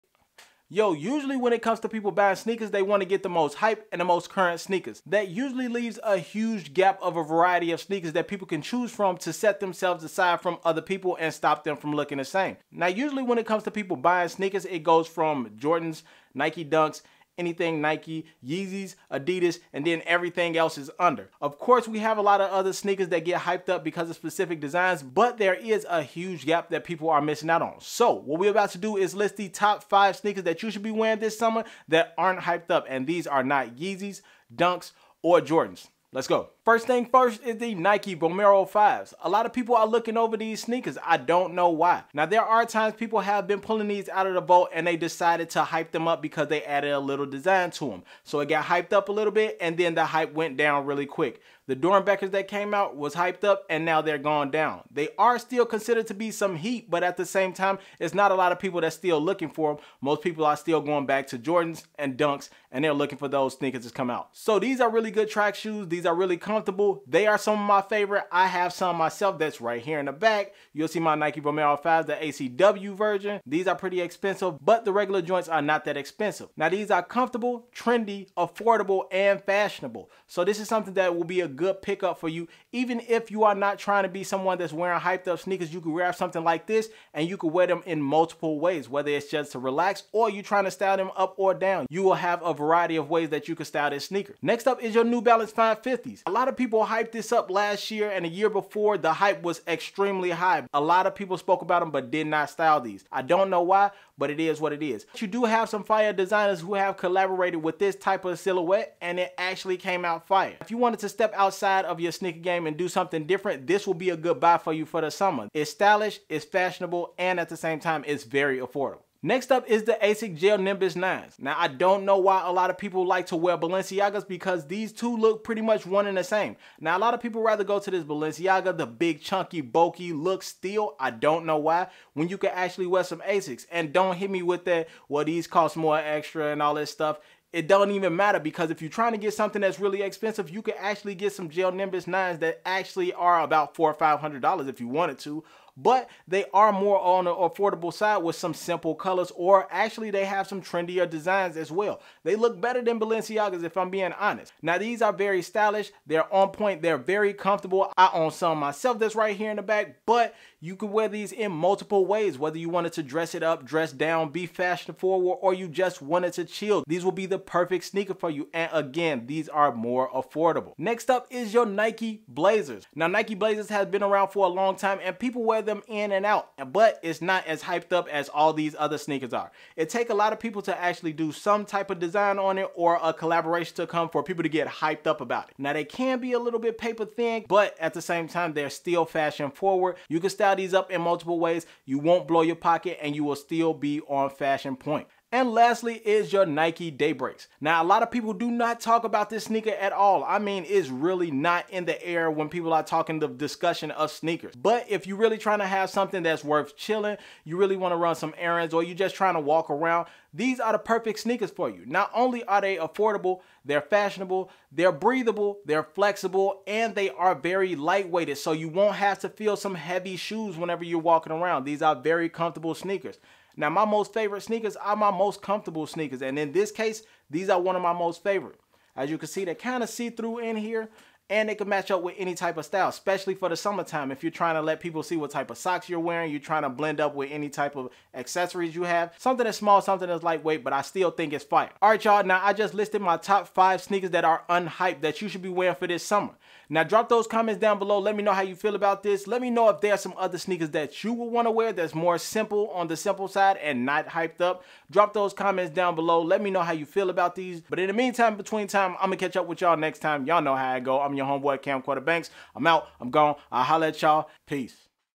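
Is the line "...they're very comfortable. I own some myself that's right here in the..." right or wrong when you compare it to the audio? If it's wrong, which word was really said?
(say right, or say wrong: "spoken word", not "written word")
right.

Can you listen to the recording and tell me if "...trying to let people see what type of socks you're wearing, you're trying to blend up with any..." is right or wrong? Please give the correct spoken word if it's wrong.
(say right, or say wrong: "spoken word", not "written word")
right.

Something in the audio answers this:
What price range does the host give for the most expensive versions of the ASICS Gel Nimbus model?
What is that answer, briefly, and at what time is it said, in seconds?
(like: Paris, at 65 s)
$400 to $500, at 143 s.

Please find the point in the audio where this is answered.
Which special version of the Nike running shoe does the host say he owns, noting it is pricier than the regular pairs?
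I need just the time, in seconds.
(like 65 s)
72 s.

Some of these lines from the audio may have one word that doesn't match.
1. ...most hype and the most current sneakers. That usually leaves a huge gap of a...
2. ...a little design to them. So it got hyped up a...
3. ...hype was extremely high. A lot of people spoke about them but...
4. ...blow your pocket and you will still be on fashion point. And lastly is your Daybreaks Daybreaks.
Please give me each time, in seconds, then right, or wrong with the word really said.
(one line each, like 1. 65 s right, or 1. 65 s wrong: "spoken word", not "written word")
1. 3 s right
2. 46 s right
3. 99 s right
4. 192 s wrong: "Nike", not "Daybreaks".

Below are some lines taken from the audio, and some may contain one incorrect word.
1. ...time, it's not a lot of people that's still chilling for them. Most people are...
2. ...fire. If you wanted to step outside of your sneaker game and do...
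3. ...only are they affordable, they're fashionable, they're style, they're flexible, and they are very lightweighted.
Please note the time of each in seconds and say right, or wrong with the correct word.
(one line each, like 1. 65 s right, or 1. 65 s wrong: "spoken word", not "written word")
1. 57 s wrong: "looking", not "chilling"
2. 110 s right
3. 212 s wrong: "breathable", not "style".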